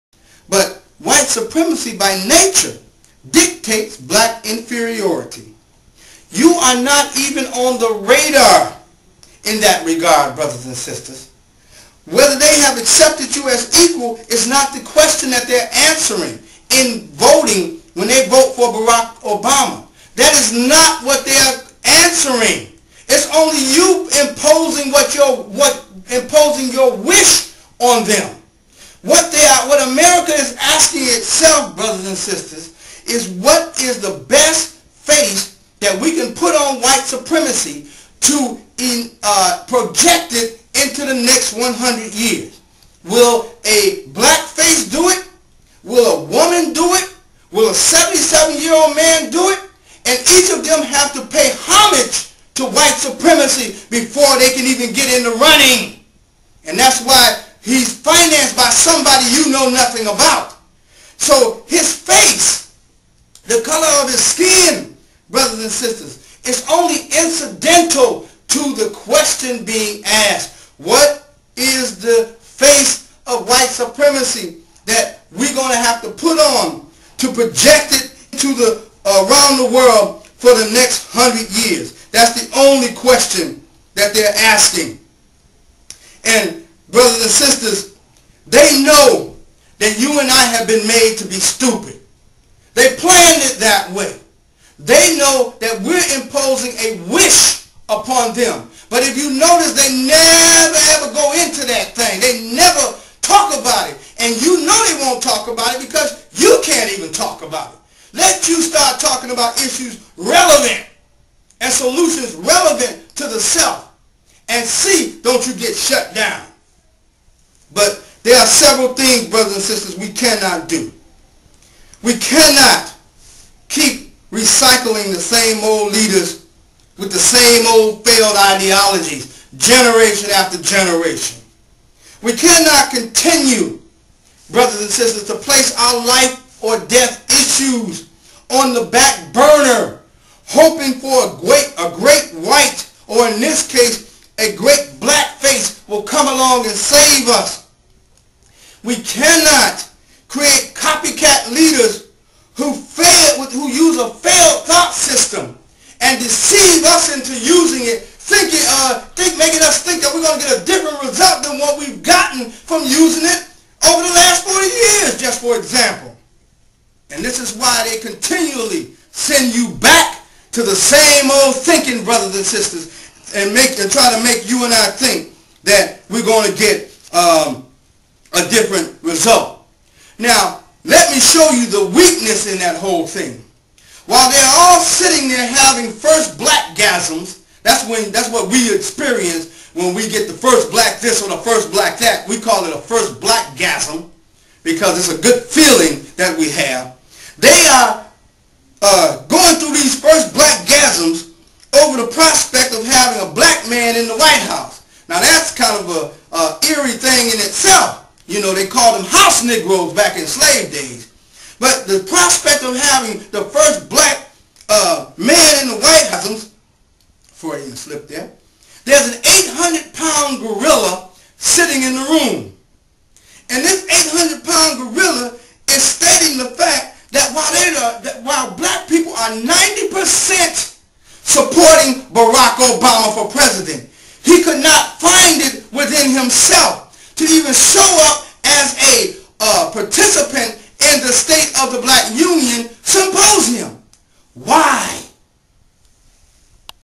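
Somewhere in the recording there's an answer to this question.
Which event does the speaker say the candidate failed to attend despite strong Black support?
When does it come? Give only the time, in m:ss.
4:01.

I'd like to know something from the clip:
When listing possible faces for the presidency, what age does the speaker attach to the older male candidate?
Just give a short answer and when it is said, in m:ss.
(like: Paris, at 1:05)
77, at 0:47.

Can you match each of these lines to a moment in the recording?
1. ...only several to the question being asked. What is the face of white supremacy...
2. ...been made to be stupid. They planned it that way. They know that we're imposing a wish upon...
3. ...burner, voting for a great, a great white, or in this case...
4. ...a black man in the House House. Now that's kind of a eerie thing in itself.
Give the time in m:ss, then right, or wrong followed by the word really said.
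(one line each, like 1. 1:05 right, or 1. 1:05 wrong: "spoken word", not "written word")
1. 1:06 wrong: "incidental", not "several"
2. 1:30 right
3. 2:19 wrong: "hoping", not "voting"
4. 3:23 wrong: "White", not "House".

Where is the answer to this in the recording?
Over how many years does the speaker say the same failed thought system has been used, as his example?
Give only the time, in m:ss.
2:44.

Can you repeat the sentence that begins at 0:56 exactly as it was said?
And that's why He's financed by somebody you know nothing about.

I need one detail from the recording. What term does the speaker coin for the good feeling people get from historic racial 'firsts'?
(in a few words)
first black gasm.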